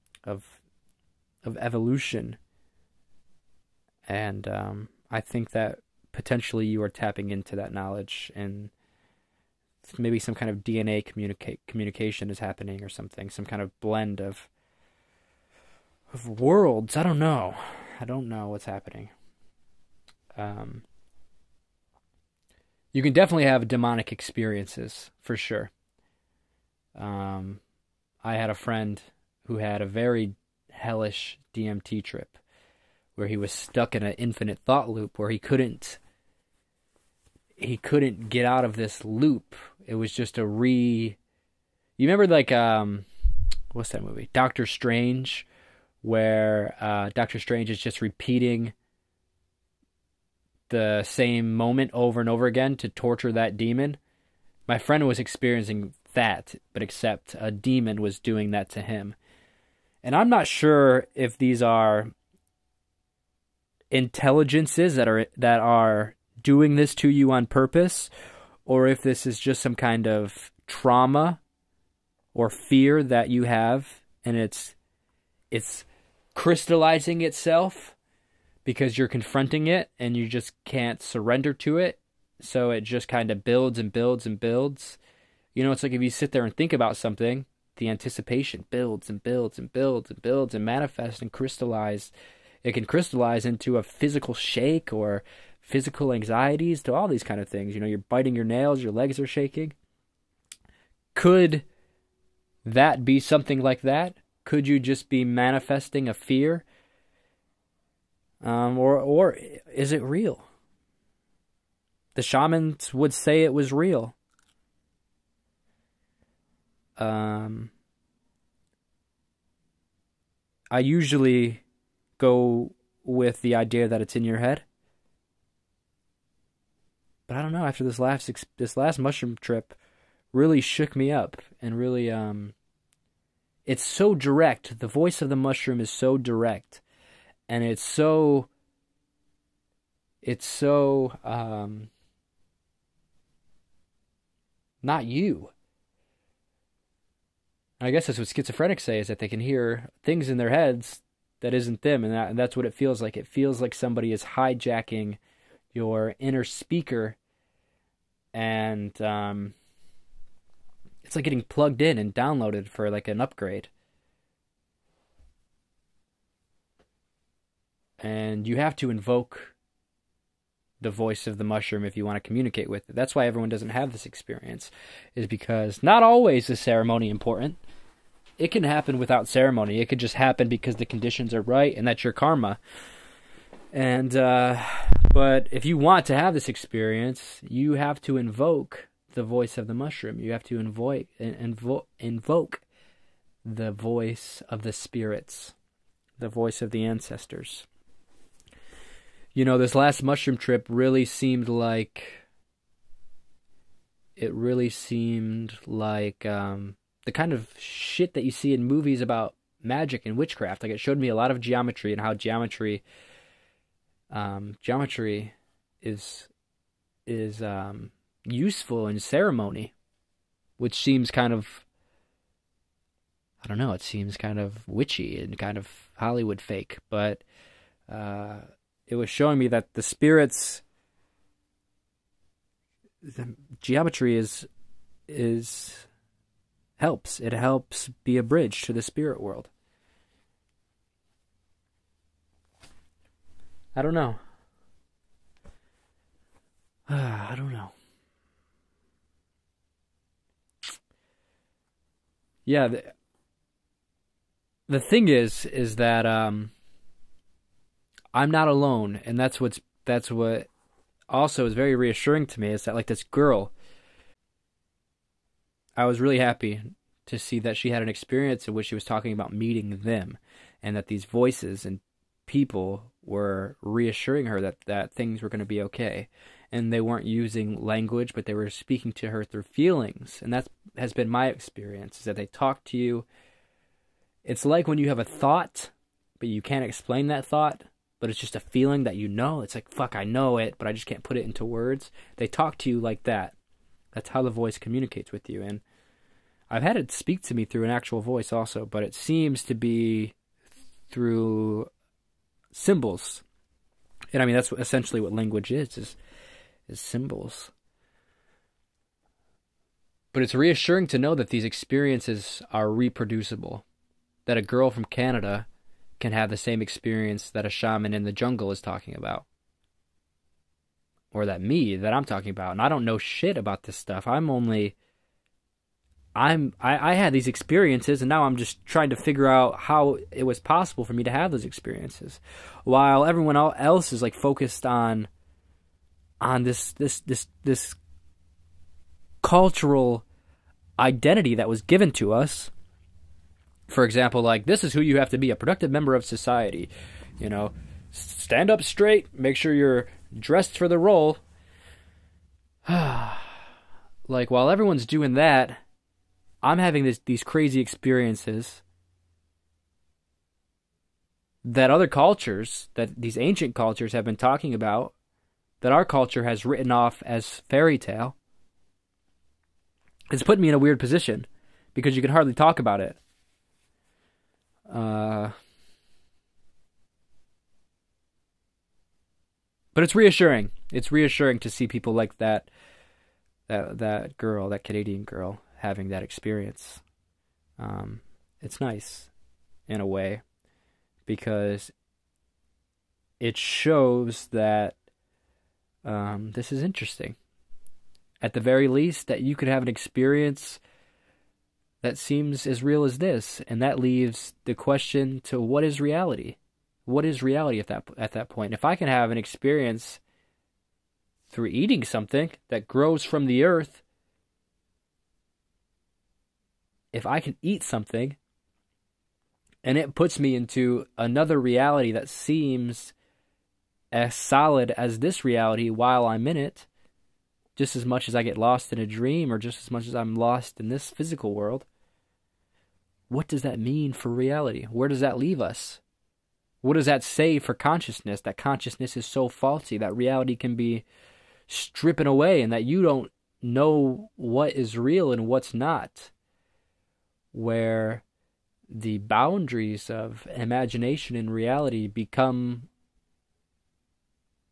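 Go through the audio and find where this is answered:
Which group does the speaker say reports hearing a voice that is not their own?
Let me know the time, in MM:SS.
02:28.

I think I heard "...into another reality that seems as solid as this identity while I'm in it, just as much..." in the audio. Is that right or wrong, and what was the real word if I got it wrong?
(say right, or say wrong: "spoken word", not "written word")
wrong: "reality", not "identity".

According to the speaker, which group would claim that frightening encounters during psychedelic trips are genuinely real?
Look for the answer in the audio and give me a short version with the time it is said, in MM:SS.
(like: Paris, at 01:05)
The shamans, at 01:52.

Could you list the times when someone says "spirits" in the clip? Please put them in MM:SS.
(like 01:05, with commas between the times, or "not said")
03:14, 03:49, 03:58.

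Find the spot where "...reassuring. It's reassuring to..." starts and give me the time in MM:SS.
06:19.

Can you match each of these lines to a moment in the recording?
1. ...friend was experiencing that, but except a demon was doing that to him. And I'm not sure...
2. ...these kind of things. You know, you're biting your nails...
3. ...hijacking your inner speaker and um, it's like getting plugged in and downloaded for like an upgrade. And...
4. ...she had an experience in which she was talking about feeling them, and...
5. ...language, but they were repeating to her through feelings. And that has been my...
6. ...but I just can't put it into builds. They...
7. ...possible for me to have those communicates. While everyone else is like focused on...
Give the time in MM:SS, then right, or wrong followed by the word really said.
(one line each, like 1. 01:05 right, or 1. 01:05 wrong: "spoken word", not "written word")
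1. 00:54 right
2. 01:37 right
3. 02:34 right
4. 04:27 wrong: "meeting", not "feeling"
5. 04:37 wrong: "speaking", not "repeating"
6. 04:50 wrong: "words", not "builds"
7. 05:30 wrong: "experiences", not "communicates".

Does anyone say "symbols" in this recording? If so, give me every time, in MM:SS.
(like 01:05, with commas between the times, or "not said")
05:02, 05:06.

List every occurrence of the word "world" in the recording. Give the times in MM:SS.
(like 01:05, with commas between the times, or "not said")
00:16, 03:59, 07:11.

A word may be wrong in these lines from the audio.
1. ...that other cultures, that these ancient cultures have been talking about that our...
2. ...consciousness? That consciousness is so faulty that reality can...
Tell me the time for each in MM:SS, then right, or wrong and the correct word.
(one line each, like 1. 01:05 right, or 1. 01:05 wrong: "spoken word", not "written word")
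1. 06:01 right
2. 07:17 right.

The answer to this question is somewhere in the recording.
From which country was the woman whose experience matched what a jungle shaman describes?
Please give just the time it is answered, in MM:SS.
05:14.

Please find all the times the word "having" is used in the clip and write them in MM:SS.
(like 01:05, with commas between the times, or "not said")
05:56, 06:25.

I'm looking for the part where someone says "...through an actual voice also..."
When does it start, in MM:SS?
04:57.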